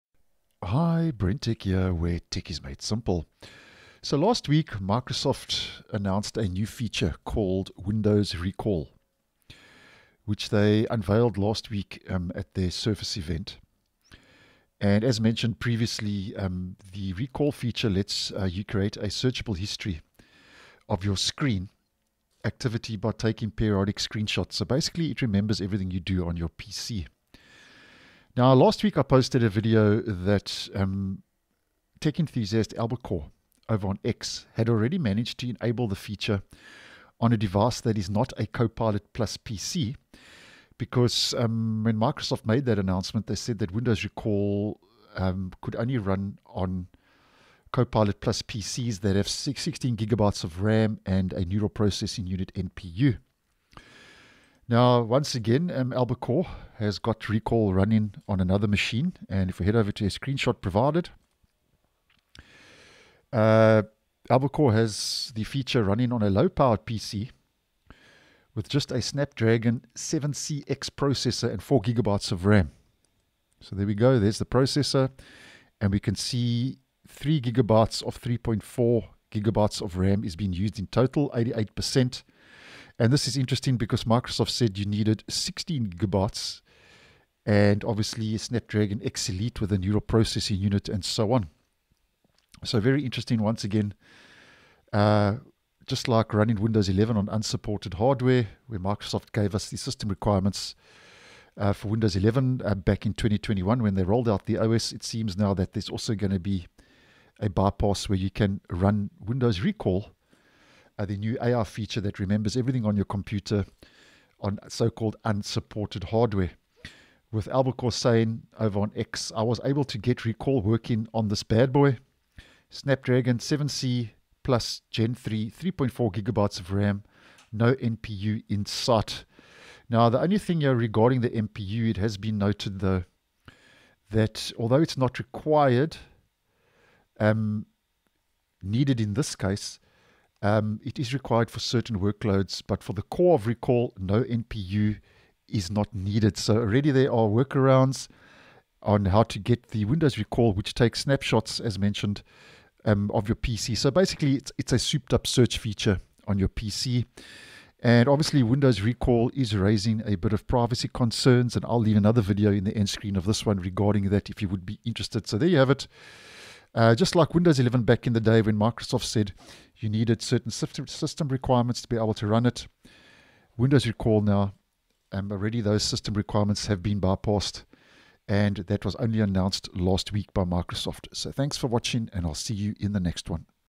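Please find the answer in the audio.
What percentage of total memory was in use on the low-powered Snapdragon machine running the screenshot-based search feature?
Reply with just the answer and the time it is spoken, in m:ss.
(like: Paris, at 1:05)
88%, at 1:21.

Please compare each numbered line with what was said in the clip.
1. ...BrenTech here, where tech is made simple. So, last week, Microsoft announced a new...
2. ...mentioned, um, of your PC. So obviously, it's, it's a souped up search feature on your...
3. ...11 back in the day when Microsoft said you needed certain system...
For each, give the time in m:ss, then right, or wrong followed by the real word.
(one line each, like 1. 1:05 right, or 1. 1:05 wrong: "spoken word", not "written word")
1. 0:01 right
2. 2:31 wrong: "basically", not "obviously"
3. 2:47 right.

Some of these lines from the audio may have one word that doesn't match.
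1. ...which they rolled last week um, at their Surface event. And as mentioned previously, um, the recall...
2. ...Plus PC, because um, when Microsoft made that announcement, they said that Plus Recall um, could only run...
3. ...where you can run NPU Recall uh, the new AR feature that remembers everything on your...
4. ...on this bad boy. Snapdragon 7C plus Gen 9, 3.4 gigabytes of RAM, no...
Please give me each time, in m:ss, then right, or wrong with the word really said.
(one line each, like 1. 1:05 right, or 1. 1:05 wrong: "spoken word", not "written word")
1. 0:10 wrong: "unveiled", not "rolled"
2. 0:39 wrong: "Windows", not "Plus"
3. 1:48 wrong: "Windows", not "NPU"
4. 2:01 wrong: "3", not "9".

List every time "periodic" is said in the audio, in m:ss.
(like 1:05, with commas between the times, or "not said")
0:23.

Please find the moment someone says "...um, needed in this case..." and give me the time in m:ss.
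2:17.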